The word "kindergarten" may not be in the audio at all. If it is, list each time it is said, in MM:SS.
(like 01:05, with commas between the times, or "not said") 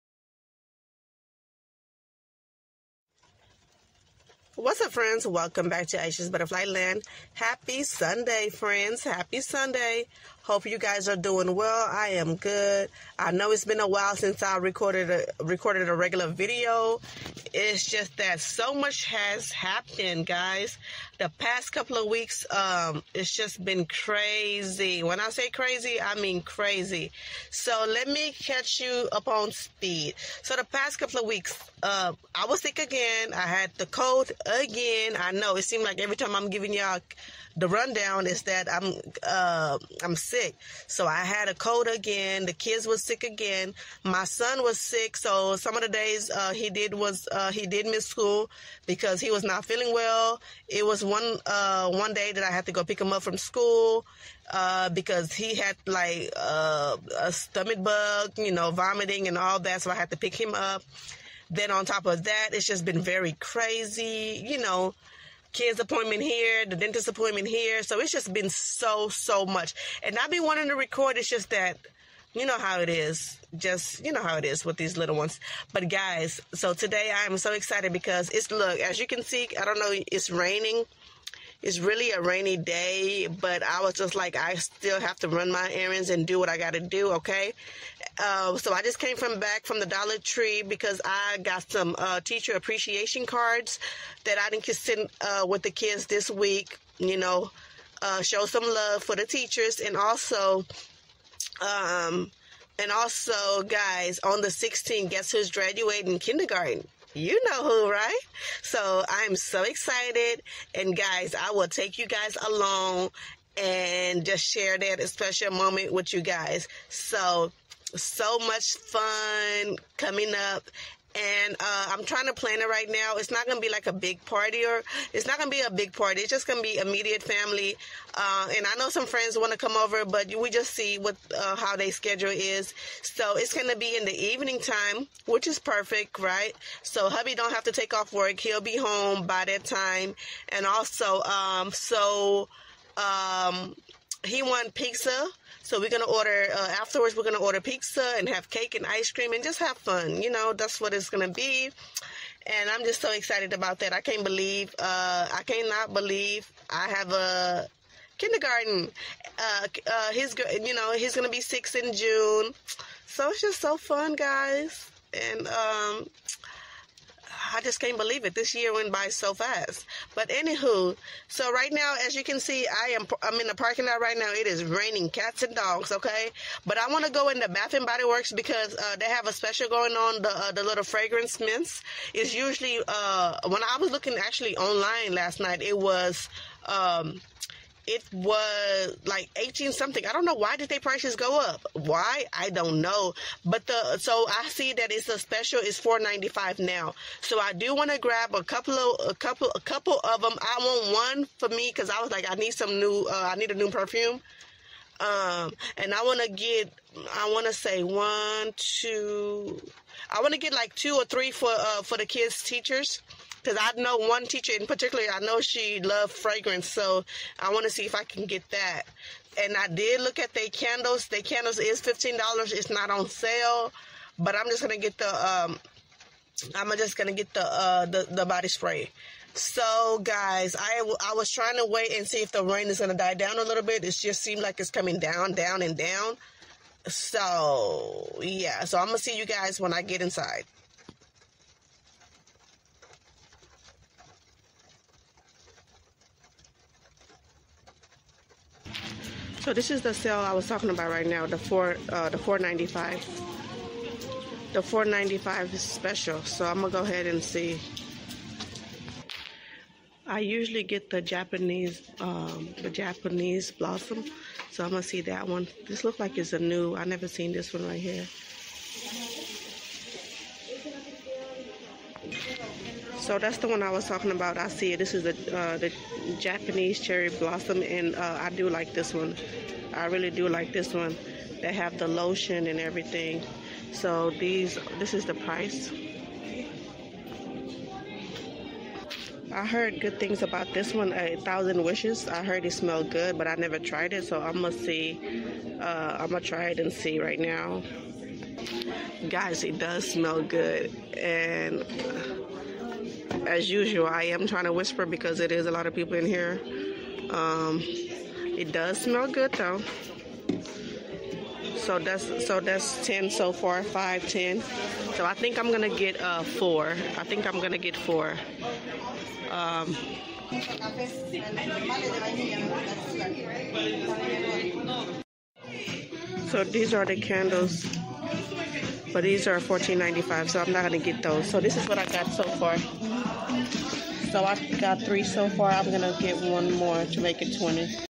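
01:46, 02:38.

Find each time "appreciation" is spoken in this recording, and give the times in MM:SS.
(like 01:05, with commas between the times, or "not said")
01:32.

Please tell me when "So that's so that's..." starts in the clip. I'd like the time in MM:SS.
05:11.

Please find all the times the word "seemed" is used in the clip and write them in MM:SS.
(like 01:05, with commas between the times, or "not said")
00:35, 03:54.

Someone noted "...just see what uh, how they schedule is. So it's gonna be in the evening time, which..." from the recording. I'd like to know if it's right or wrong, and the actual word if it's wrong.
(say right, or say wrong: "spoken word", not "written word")
right.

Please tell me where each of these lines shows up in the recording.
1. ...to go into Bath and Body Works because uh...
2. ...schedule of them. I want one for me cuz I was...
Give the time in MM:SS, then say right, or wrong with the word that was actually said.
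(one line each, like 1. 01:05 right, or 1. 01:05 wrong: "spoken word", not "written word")
1. 02:57 right
2. 03:19 wrong: "couple", not "schedule".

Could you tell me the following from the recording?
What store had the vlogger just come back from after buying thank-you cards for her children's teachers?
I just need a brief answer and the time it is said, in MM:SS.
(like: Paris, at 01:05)
Dollar Tree, at 01:29.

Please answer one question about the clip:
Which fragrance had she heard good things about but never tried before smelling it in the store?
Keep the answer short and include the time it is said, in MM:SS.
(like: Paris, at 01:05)
A Thousand Wishes, at 04:50.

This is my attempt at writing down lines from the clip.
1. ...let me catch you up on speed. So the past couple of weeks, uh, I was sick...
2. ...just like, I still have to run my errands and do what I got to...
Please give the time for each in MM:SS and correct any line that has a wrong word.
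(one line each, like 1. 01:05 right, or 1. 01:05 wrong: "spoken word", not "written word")
1. 00:27 right
2. 01:23 right.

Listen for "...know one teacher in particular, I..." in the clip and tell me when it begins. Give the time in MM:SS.
03:33.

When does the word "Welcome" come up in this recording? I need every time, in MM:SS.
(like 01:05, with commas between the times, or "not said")
00:05.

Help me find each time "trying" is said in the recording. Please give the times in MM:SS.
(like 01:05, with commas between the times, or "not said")
02:02, 03:51, 05:04.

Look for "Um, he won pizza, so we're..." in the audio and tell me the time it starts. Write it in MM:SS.
02:22.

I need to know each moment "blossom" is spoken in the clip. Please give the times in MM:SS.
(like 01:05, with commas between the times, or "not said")
04:23, 04:37.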